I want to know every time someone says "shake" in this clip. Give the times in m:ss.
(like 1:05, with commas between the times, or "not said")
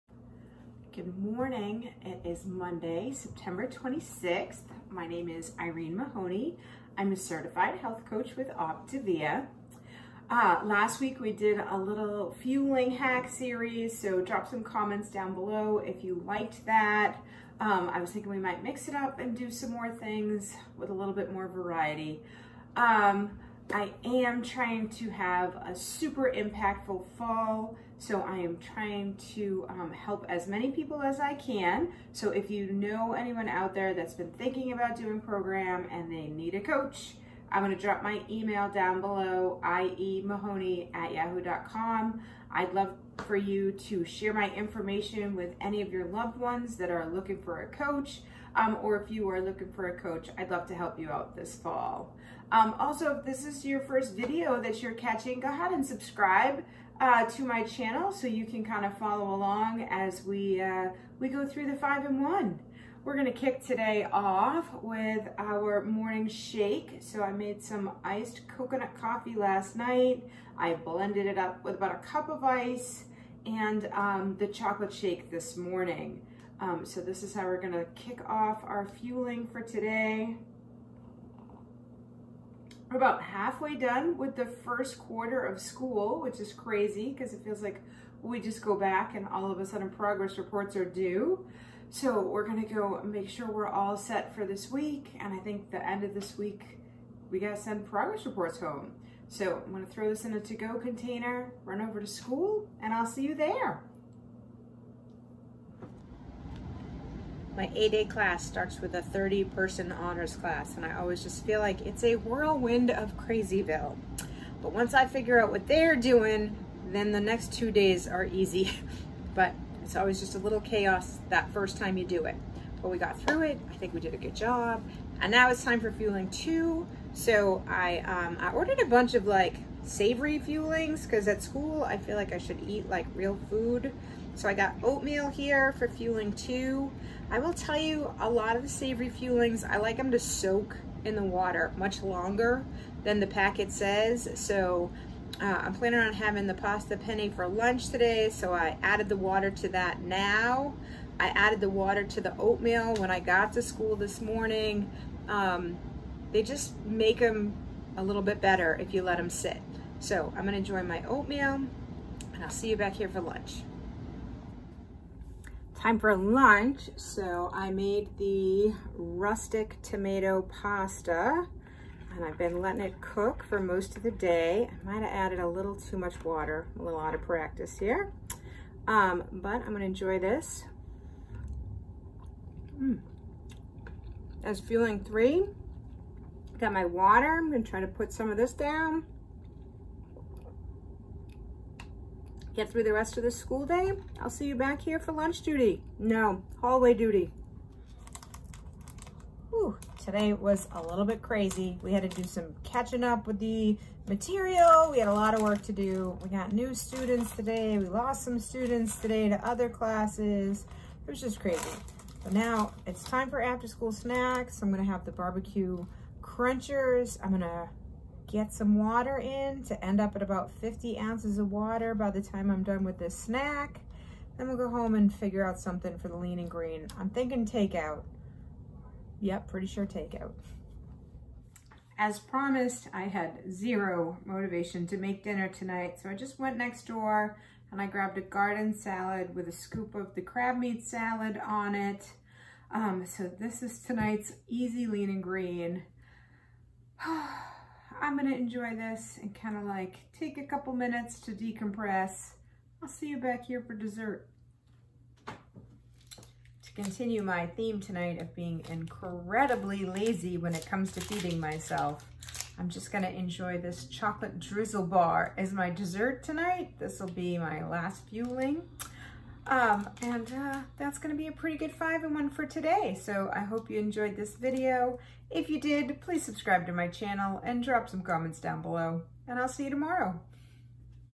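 1:06, 1:14.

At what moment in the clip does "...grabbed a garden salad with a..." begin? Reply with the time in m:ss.
3:57.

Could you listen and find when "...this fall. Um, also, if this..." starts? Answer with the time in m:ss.
0:51.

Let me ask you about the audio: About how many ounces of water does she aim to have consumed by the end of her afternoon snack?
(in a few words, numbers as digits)
50.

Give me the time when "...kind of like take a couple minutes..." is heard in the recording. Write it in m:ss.
4:09.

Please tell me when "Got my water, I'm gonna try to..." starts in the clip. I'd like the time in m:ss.
3:06.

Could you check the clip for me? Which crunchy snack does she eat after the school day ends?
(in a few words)
Barbecue crunchers.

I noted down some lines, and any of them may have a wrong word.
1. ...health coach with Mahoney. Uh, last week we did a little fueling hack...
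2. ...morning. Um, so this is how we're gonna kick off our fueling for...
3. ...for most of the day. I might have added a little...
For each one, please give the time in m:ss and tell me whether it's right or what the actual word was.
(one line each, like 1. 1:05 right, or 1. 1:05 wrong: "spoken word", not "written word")
1. 0:07 wrong: "Optavia", not "Mahoney"
2. 1:15 right
3. 2:53 right.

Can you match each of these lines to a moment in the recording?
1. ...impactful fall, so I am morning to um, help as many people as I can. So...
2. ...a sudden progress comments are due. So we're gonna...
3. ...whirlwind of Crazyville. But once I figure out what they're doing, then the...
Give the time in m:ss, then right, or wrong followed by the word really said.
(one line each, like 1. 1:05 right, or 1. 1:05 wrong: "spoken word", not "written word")
1. 0:26 wrong: "trying", not "morning"
2. 1:29 wrong: "reports", not "comments"
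3. 1:52 right.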